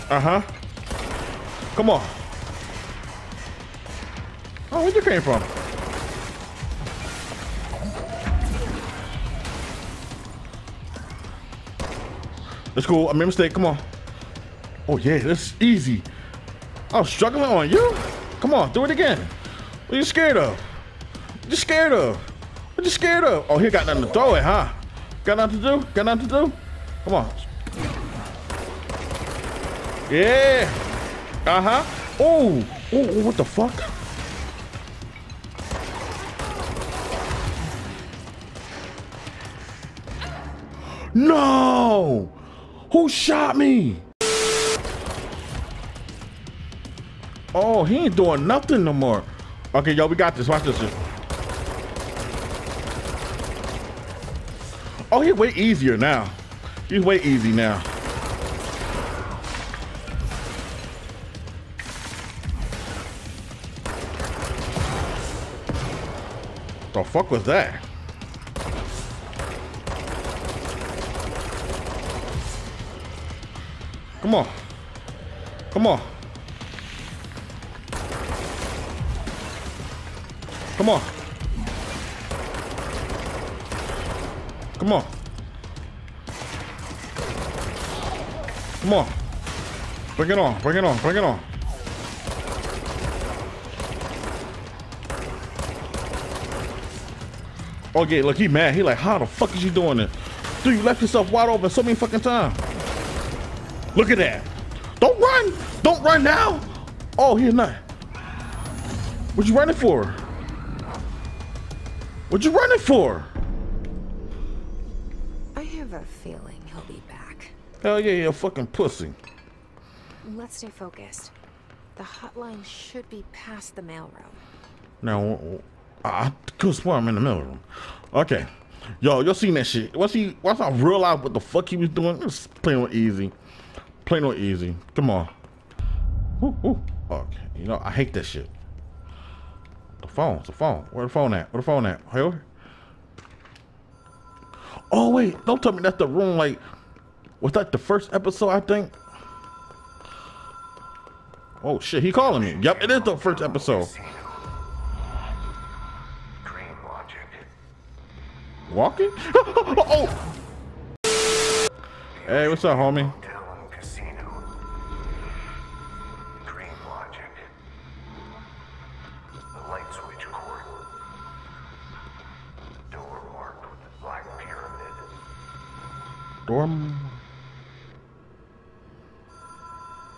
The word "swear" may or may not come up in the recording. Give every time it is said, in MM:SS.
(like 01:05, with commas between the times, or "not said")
02:06.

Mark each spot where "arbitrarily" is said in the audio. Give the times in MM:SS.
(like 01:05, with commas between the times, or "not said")
not said.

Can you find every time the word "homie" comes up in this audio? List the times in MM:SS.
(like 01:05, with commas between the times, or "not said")
02:42.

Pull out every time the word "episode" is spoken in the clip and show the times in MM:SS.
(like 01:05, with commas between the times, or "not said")
02:28, 02:33.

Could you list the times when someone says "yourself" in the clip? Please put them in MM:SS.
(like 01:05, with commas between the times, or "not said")
01:41.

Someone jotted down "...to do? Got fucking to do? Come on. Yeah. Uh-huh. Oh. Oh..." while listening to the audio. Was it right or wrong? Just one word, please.
wrong.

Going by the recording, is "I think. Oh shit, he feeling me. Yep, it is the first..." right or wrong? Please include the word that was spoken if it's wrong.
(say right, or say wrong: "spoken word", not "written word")
wrong: "calling", not "feeling".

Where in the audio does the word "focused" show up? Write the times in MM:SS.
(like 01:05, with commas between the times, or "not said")
02:00.